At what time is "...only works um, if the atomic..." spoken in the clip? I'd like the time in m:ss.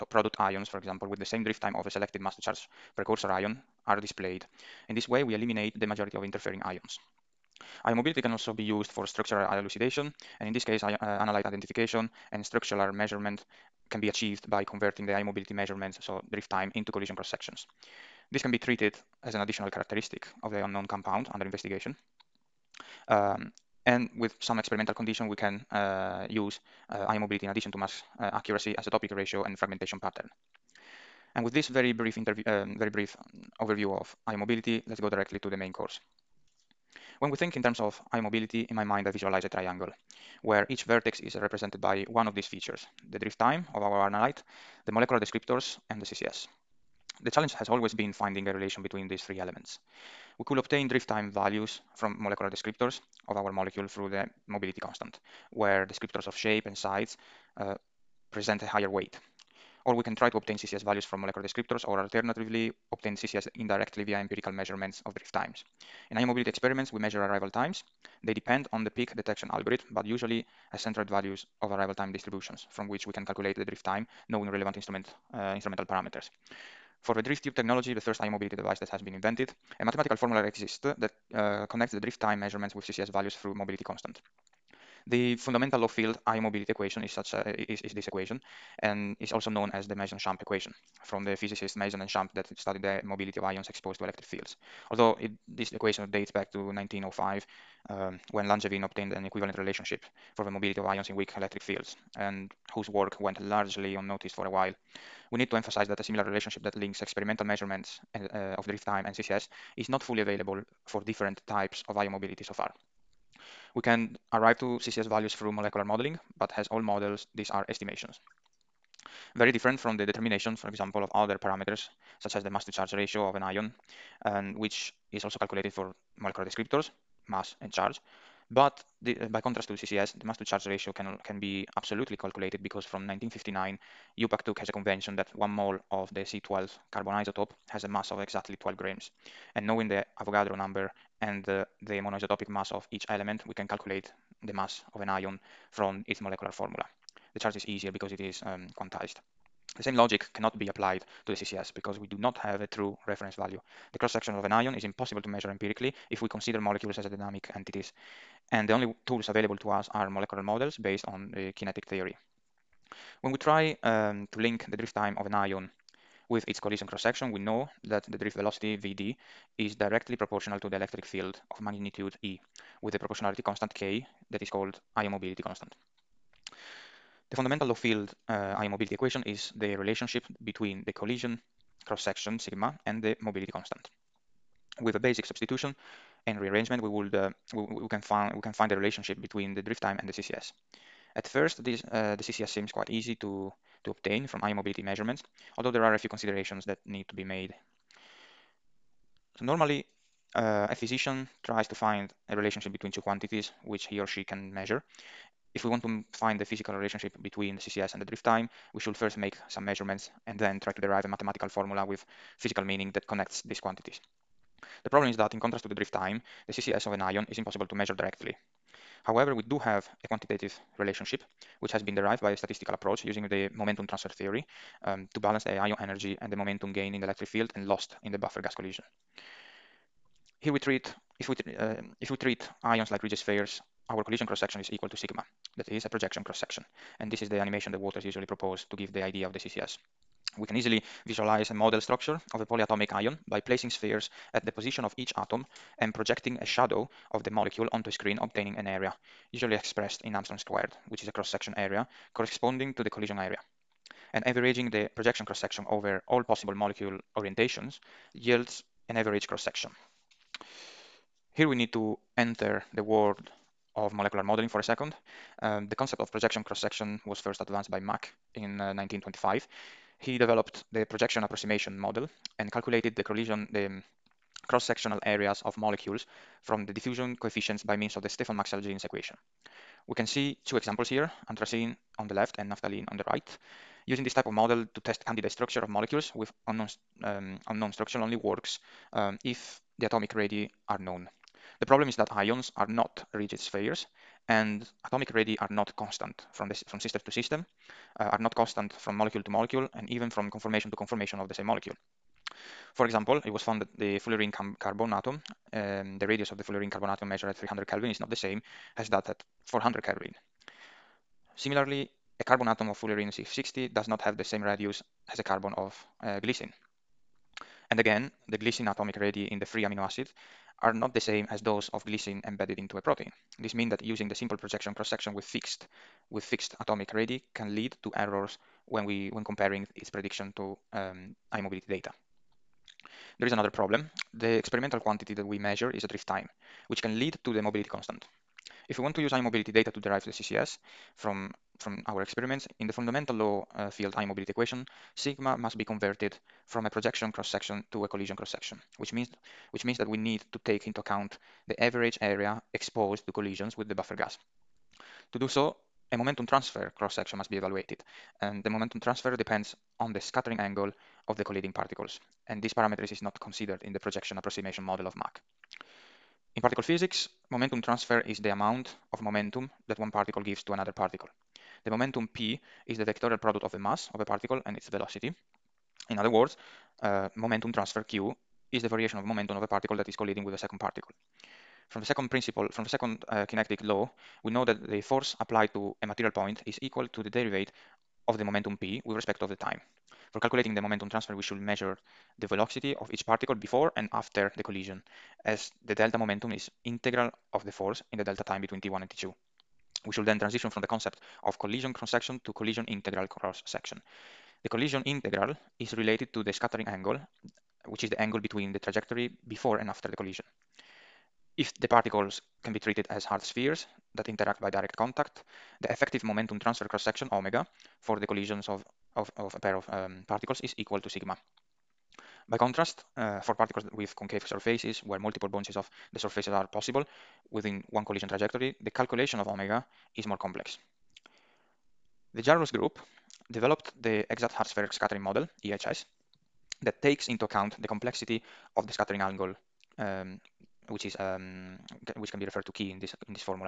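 4:47.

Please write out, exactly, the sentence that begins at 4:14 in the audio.
And averaging the projection cross-section over all possible molecule orientations yields an average cross-section.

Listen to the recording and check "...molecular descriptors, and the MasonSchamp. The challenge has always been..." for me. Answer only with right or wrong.
wrong.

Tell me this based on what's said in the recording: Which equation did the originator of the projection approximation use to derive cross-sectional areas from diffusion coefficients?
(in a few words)
Stefan-Maxwell-Jeans equation.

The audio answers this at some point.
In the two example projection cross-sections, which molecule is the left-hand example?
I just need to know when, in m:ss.
4:41.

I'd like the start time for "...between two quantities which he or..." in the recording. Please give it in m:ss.
3:22.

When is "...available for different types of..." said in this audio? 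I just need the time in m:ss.
1:50.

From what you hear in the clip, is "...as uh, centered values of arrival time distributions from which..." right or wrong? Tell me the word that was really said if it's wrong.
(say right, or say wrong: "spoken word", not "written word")
right.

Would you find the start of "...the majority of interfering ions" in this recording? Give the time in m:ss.
0:05.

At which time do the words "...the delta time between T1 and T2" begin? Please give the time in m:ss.
6:37.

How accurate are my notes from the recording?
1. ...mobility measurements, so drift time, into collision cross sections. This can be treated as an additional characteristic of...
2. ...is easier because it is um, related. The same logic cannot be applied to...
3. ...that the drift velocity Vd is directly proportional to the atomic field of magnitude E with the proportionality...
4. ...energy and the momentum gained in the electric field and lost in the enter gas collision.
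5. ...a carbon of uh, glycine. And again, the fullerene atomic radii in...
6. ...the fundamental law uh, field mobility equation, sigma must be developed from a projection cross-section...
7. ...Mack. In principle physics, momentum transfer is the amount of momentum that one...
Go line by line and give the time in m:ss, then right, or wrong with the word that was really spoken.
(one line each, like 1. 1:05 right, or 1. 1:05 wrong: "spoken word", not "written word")
1. 0:15 right
2. 2:27 wrong: "quantized", not "related"
3. 2:47 wrong: "electric", not "atomic"
4. 3:45 wrong: "buffer", not "enter"
5. 5:15 wrong: "glycine", not "fullerene"
6. 5:42 wrong: "converted", not "developed"
7. 6:04 wrong: "particle", not "principle".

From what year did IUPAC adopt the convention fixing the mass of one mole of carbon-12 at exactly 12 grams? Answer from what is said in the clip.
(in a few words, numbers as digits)
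1959.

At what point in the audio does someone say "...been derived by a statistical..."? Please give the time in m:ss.
3:41.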